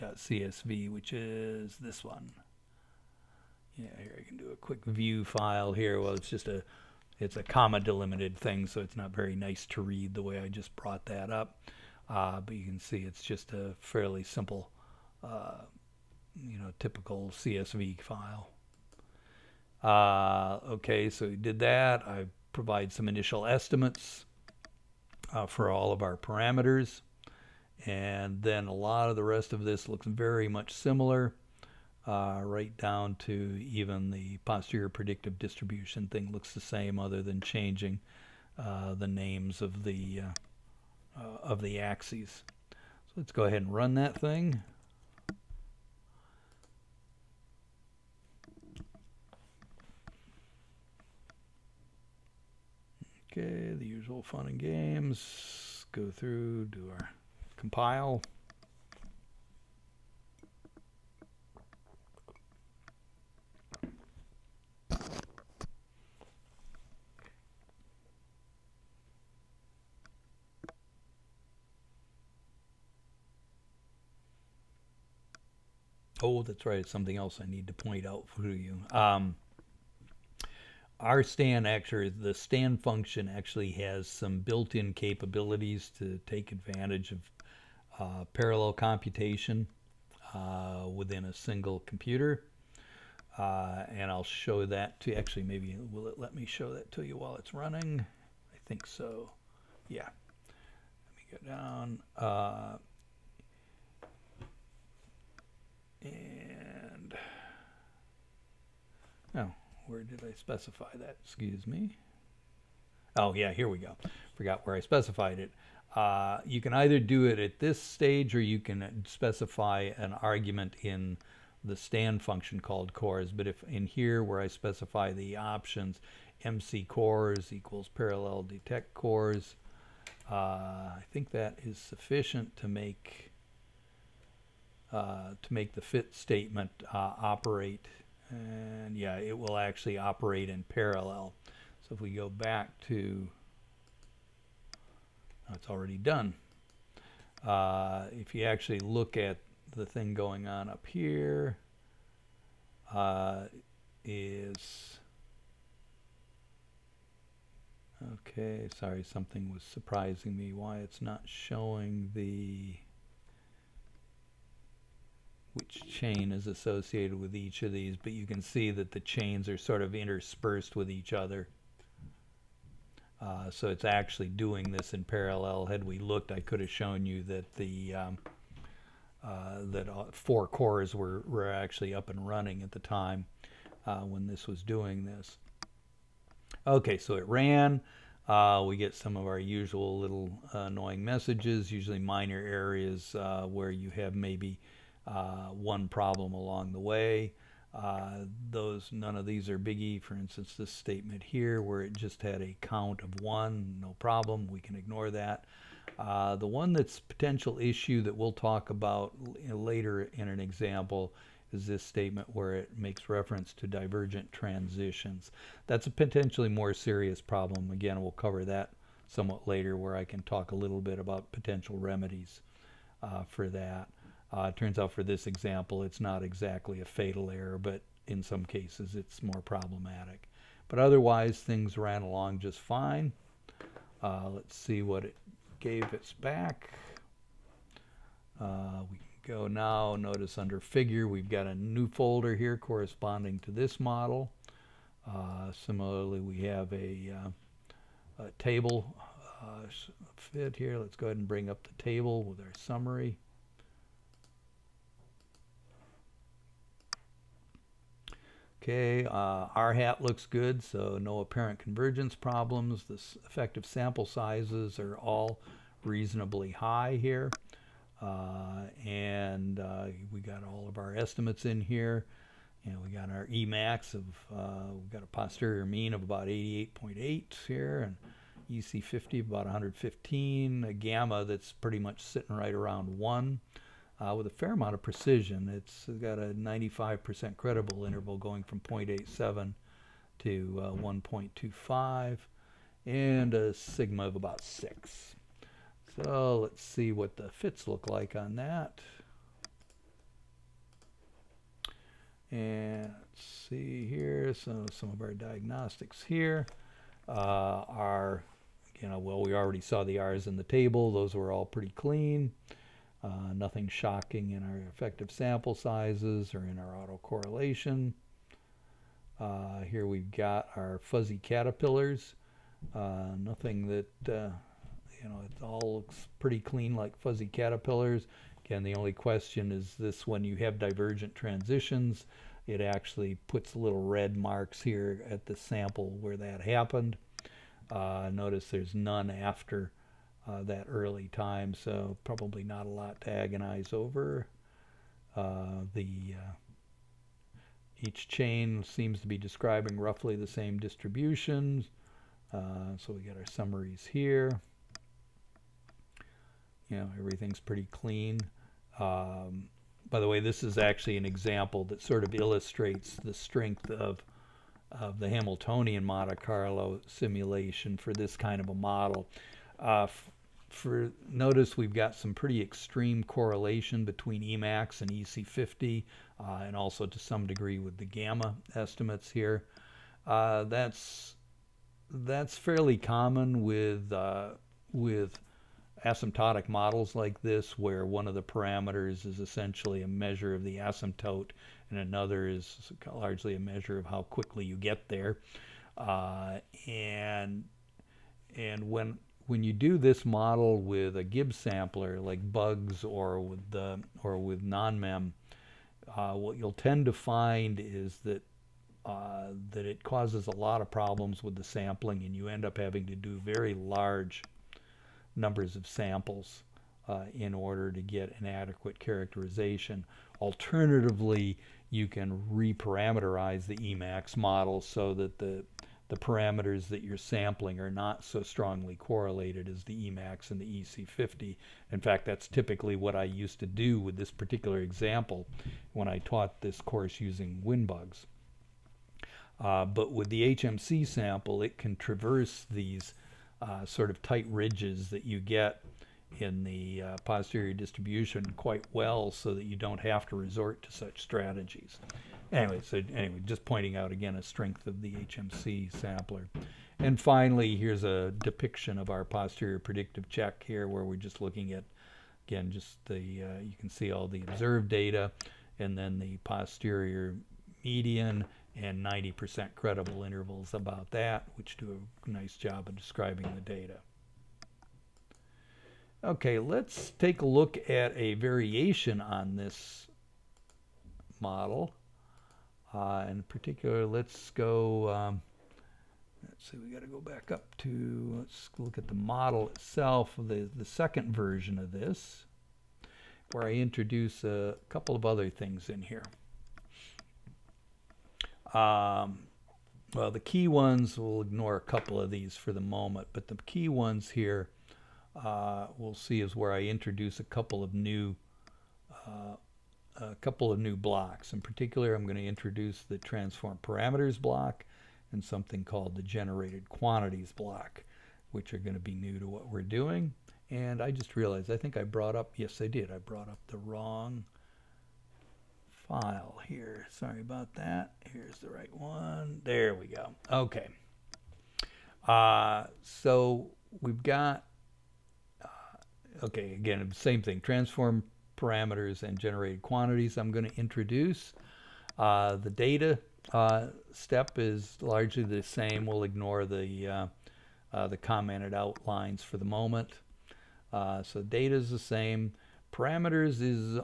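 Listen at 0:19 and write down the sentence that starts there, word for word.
Uh, okay, so we did that.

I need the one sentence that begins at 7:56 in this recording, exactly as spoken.
Okay, let's take a look at a variation on this model.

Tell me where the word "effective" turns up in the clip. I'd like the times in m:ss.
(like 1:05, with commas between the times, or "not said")
4:23, 5:14.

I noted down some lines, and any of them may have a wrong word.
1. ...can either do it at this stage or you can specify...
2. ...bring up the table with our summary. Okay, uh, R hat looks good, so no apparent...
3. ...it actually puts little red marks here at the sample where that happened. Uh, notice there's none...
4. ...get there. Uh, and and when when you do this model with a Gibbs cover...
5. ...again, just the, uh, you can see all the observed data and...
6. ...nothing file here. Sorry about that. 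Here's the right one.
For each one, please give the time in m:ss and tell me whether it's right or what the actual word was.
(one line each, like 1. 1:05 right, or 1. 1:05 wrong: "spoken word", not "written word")
1. 1:56 right
2. 4:11 right
3. 5:32 right
4. 6:34 wrong: "sampler", not "cover"
5. 7:42 right
6. 8:43 wrong: "wrong", not "nothing".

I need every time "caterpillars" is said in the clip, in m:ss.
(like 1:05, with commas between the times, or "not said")
5:21, 5:27.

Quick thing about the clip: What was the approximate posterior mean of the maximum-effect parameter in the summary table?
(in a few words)
88.8.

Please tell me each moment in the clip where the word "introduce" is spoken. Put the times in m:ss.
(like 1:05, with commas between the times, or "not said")
8:13, 8:26, 8:32, 9:00.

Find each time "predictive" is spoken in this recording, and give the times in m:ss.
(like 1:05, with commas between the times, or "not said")
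0:34, 7:39.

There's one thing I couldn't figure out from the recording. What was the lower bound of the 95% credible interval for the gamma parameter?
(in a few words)
0.87.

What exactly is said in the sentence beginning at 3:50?
But otherwise, things ran along just fine.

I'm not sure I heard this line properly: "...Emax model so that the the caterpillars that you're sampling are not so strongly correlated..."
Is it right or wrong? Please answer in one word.
wrong.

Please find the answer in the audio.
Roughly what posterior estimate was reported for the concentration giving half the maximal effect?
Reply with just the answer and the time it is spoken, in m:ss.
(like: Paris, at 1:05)
115, at 4:39.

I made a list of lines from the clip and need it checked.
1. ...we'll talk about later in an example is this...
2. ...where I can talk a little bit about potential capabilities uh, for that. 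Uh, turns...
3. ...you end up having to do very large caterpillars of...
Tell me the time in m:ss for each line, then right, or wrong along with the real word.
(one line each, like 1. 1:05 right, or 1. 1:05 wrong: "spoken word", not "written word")
1. 3:28 right
2. 3:39 wrong: "remedies", not "capabilities"
3. 6:52 wrong: "numbers", not "caterpillars".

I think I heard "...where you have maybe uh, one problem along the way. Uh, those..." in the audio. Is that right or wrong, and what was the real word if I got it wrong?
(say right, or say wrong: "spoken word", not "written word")
right.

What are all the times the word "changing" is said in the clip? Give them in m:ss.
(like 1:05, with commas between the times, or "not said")
0:37.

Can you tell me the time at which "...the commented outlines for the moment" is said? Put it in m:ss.
9:07.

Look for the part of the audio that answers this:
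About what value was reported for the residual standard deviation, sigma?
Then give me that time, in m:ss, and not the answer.
4:54.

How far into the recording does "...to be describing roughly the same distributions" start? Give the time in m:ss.
5:49.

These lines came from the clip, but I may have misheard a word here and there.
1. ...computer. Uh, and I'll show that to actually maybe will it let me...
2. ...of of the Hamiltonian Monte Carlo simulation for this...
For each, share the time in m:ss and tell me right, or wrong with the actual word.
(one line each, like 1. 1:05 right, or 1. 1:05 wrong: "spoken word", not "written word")
1. 1:31 right
2. 6:03 right.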